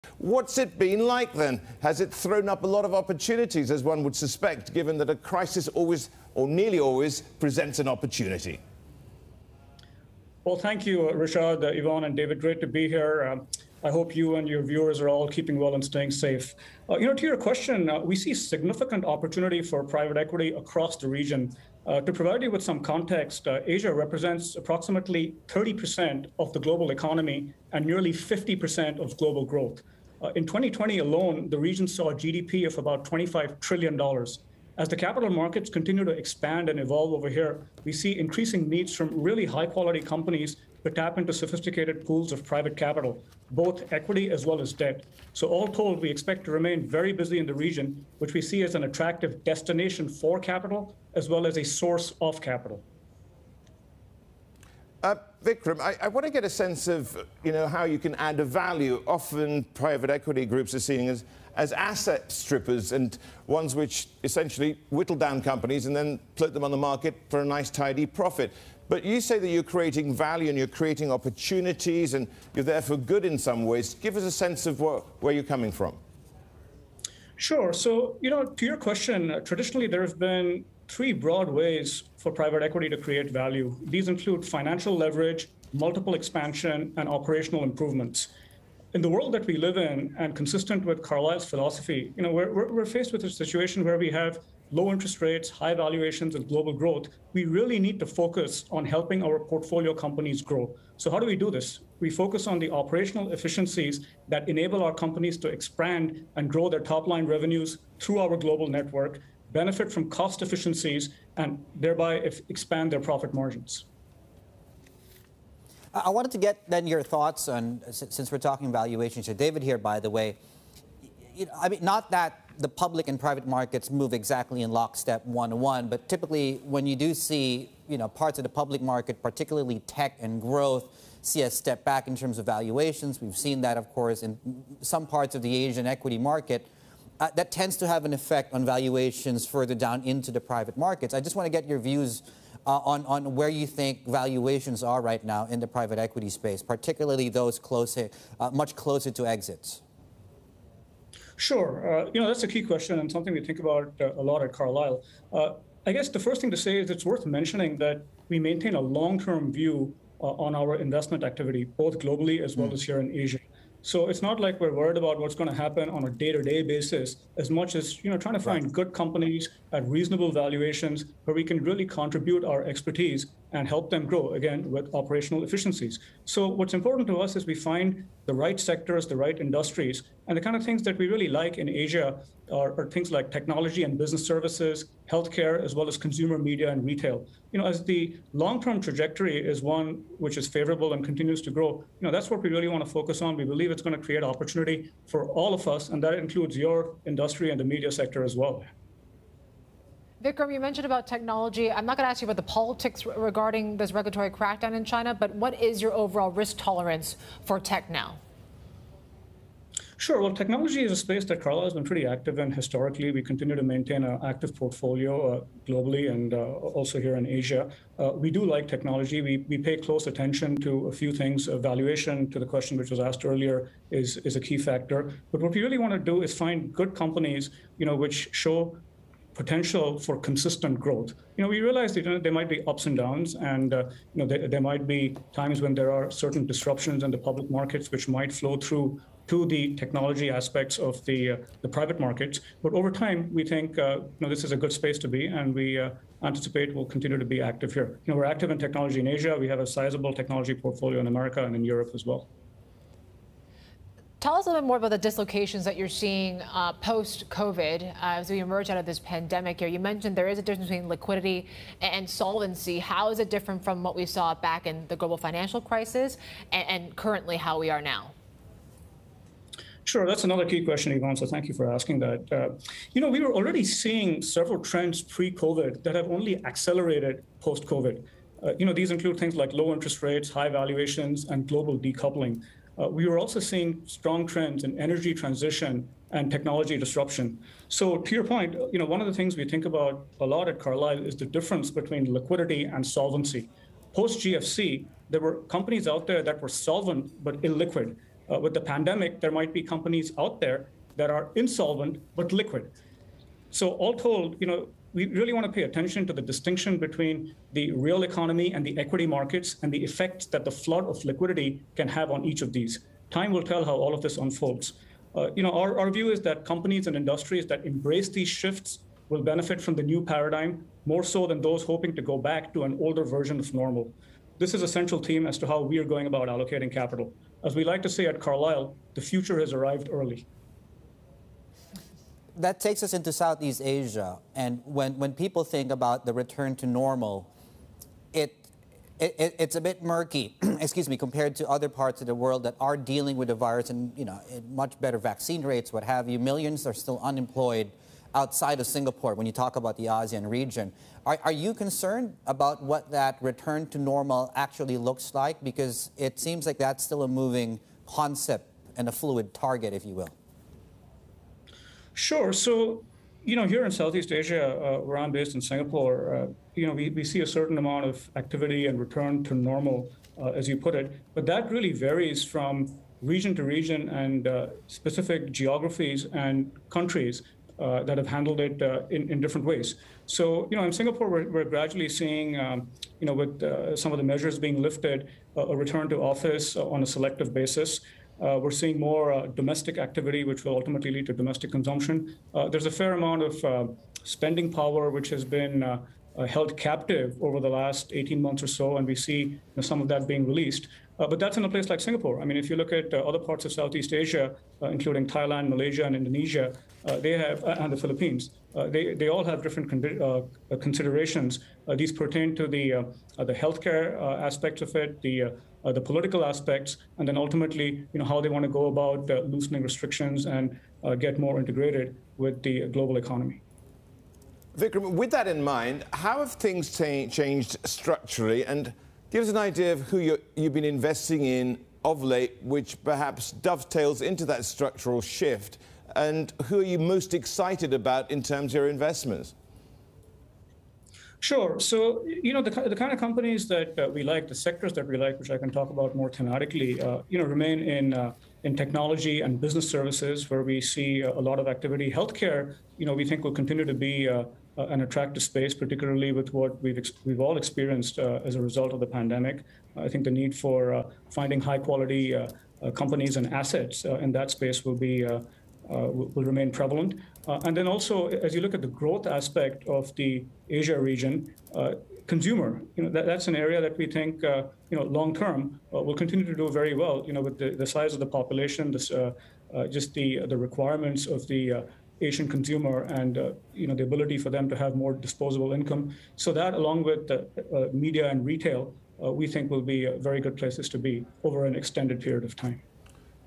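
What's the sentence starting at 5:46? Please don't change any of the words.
Millions are still unemployed outside of Singapore when you talk about the ASEAN region.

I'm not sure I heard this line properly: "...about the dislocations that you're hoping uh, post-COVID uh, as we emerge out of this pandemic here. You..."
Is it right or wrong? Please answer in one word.
wrong.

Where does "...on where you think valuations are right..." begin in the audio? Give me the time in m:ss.
2:23.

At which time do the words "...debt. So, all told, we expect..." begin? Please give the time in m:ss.
0:44.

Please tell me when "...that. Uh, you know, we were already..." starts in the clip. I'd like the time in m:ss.
4:32.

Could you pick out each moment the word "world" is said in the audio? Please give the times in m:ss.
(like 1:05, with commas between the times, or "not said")
1:29, 5:42.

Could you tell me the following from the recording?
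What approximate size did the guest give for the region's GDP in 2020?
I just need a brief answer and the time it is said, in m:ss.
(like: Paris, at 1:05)
$25 trillion, at 0:33.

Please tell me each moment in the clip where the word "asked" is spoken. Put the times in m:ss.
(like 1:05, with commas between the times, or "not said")
3:42.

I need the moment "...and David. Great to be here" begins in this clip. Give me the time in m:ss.
0:12.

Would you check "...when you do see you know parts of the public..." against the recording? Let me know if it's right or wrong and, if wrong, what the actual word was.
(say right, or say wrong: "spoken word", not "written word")
right.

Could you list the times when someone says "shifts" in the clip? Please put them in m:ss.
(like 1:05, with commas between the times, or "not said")
5:18, 7:15.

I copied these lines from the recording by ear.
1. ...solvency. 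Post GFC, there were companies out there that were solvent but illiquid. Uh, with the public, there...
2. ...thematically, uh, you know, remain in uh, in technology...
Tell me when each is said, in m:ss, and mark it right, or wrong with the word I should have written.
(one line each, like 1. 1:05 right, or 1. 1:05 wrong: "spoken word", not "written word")
1. 4:52 wrong: "pandemic", not "public"
2. 7:26 right.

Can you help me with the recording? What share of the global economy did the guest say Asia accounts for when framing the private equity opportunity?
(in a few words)
30%.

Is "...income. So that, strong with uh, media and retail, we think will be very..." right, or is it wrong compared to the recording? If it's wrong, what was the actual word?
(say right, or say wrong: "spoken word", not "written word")
wrong: "along", not "strong".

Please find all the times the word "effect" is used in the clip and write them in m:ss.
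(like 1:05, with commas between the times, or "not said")
2:18, 5:09.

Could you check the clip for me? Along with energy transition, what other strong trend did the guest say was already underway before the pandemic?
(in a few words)
Technology disruption.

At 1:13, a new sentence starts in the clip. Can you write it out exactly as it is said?
Give us a sense of what, where you're coming from.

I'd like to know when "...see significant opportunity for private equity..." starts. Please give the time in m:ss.
0:18.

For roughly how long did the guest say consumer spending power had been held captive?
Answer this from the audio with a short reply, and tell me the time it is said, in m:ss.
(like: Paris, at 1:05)
18 months, at 6:37.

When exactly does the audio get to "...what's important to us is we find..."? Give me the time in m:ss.
2:56.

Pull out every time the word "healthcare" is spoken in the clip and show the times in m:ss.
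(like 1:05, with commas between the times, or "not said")
3:05, 6:53, 7:31.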